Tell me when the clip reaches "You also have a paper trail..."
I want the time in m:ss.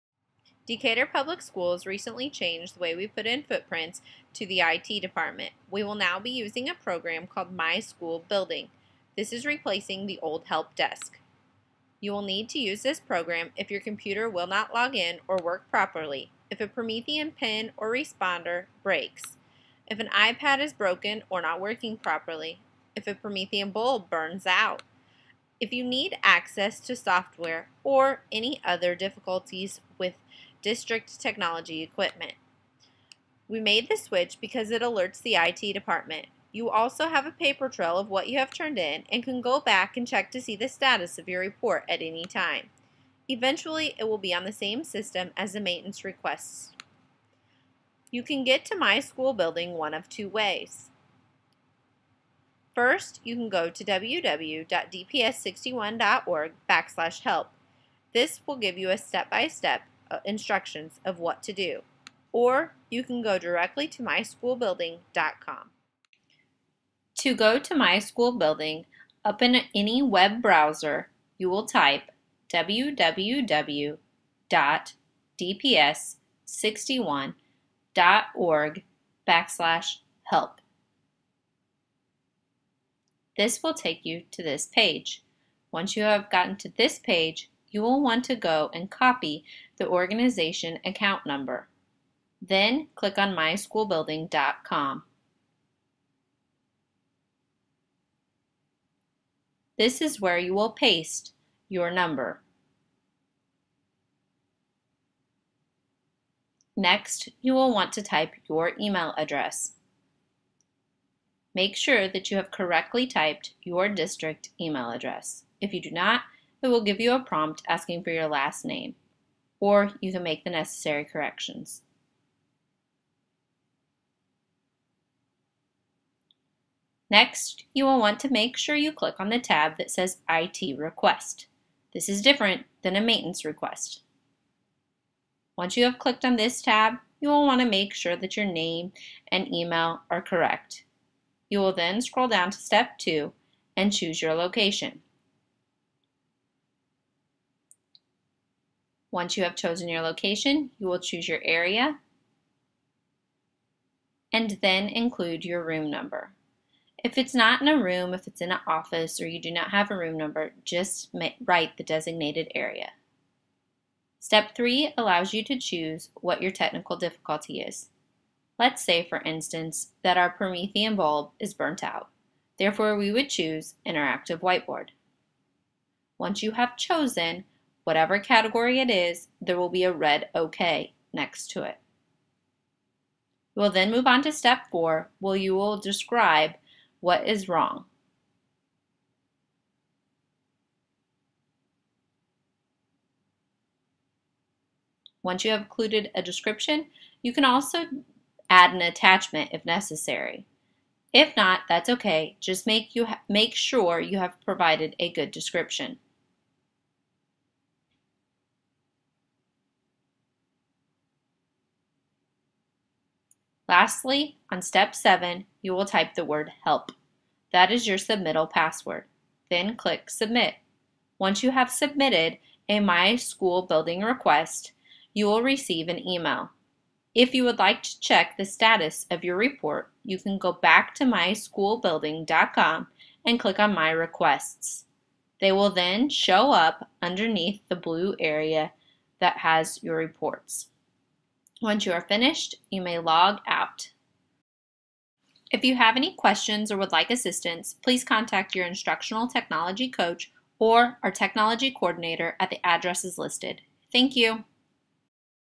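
0:36.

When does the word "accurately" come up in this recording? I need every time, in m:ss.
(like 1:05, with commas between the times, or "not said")
not said.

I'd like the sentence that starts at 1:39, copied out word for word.
This is where you will paste your number.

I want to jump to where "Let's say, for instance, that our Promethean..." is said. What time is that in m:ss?
2:48.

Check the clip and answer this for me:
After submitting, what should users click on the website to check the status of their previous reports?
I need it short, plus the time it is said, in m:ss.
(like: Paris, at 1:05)
My Requests, at 3:53.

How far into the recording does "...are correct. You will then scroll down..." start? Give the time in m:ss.
2:20.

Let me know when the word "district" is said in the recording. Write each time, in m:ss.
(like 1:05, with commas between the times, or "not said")
0:30, 1:53.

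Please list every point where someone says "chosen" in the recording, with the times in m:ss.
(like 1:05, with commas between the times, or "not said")
2:29, 2:56.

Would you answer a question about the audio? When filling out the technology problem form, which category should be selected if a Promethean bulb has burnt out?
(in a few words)
Interactive Whiteboard.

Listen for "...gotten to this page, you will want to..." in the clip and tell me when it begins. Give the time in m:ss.
1:26.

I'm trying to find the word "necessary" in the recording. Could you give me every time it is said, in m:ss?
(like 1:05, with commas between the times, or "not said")
2:00, 3:19.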